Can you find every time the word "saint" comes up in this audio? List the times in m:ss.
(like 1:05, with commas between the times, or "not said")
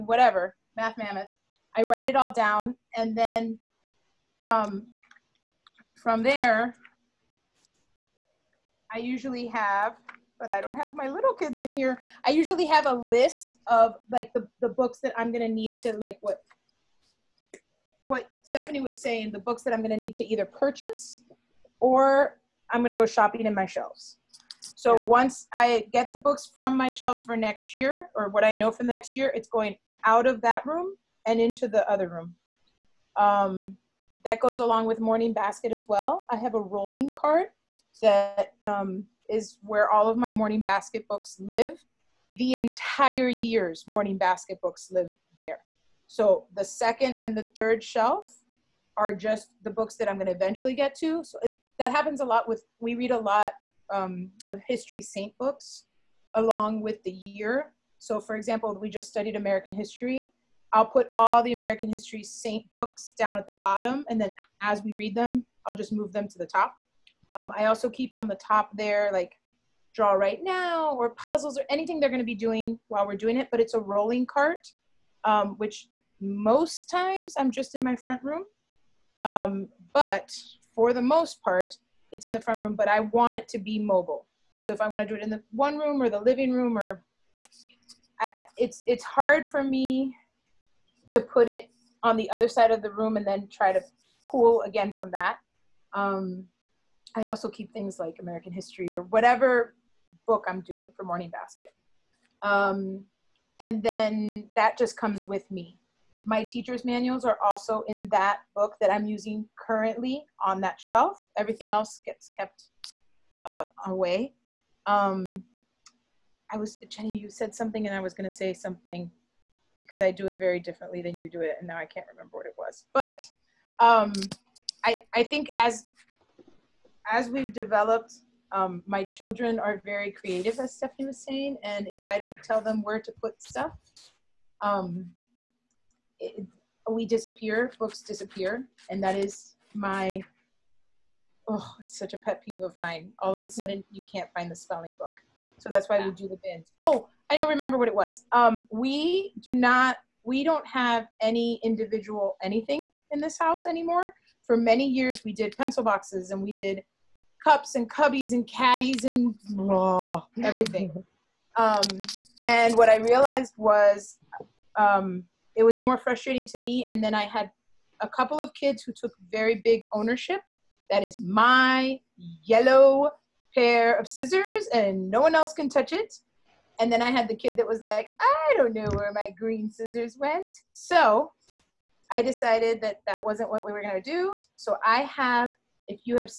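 0:55, 1:02.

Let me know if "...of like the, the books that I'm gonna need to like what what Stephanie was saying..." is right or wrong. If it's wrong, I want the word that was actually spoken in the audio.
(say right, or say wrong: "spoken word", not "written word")
right.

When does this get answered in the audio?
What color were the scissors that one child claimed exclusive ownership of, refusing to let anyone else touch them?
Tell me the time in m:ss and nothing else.
2:52.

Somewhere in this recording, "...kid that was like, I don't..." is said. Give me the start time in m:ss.
2:57.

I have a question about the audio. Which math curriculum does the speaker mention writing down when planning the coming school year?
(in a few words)
Math Mammoth.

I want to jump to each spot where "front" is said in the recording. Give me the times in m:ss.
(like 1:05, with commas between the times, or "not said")
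1:17, 1:22.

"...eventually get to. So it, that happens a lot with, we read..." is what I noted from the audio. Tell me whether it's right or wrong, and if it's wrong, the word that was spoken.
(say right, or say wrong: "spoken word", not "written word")
right.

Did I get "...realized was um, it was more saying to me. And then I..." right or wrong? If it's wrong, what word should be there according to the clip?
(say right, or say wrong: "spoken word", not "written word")
wrong: "frustrating", not "saying".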